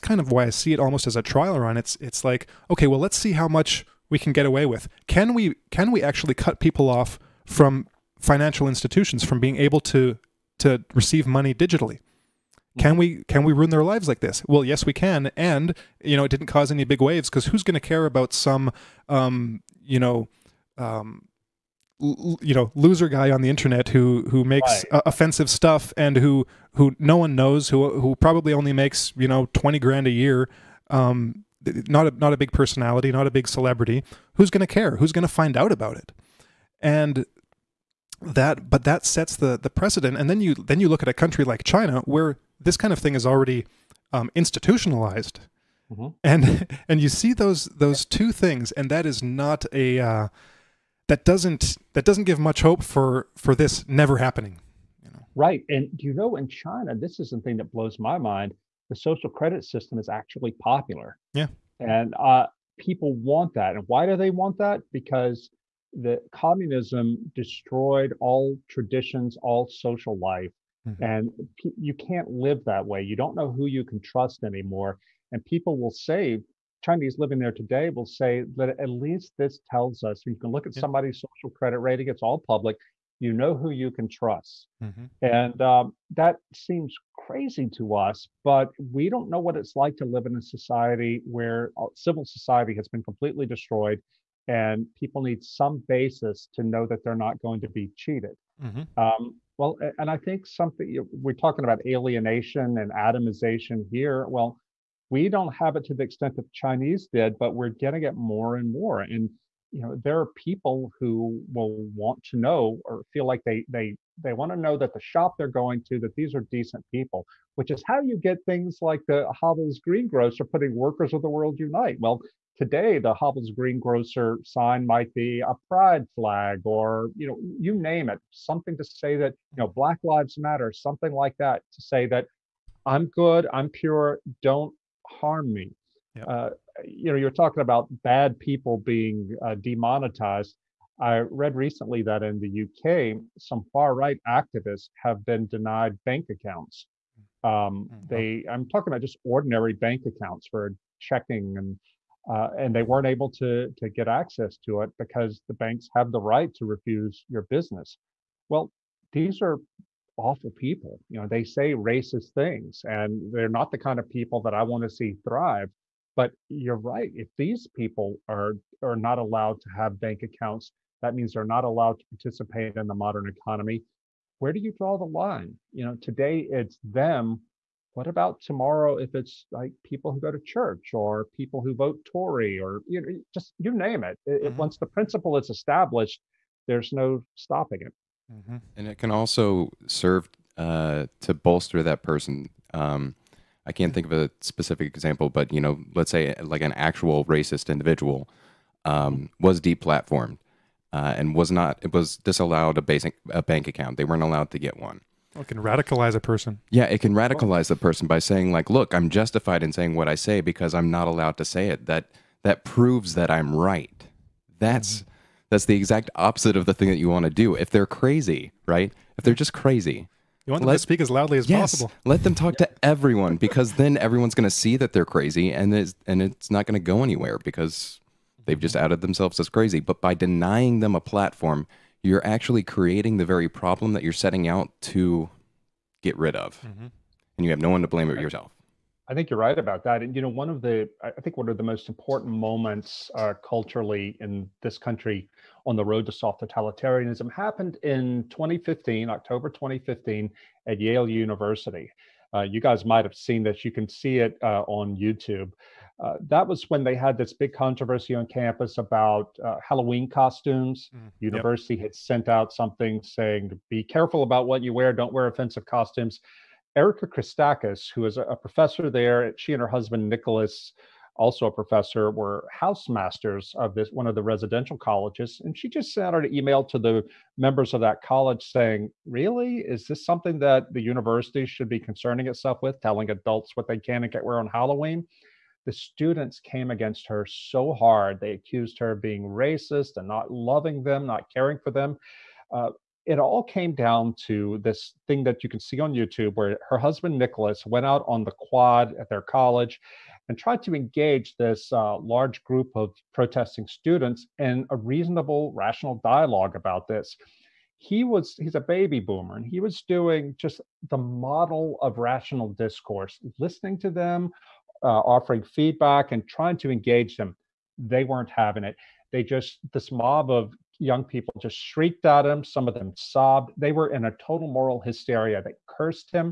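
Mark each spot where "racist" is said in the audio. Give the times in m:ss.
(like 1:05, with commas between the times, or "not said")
2:41, 3:17, 4:49.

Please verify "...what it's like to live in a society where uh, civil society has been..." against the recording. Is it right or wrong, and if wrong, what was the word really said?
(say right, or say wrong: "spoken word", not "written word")
right.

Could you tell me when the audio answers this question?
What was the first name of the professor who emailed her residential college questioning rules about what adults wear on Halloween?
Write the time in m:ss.
4:26.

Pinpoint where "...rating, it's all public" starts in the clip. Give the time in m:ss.
1:21.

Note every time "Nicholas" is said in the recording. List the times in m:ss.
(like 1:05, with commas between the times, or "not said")
4:30, 4:57.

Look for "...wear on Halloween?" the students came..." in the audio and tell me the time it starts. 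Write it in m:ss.
4:44.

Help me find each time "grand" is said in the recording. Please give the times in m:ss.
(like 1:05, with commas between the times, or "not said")
0:29.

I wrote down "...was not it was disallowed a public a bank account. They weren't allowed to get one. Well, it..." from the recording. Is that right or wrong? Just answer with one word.
wrong.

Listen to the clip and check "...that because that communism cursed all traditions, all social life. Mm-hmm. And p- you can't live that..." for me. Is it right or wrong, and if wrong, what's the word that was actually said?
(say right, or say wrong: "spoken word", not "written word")
wrong: "destroyed", not "cursed".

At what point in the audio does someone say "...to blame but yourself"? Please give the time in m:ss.
3:57.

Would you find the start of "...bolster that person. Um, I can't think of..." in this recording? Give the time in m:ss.
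3:11.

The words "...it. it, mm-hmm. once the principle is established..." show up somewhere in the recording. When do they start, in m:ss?
3:04.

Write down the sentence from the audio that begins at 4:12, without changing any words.
Uh, you guys might have seen this.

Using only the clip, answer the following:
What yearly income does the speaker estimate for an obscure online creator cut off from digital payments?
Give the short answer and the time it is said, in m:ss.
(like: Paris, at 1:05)
$20,000, at 0:29.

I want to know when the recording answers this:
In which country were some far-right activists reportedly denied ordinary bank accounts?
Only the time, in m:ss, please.
2:22.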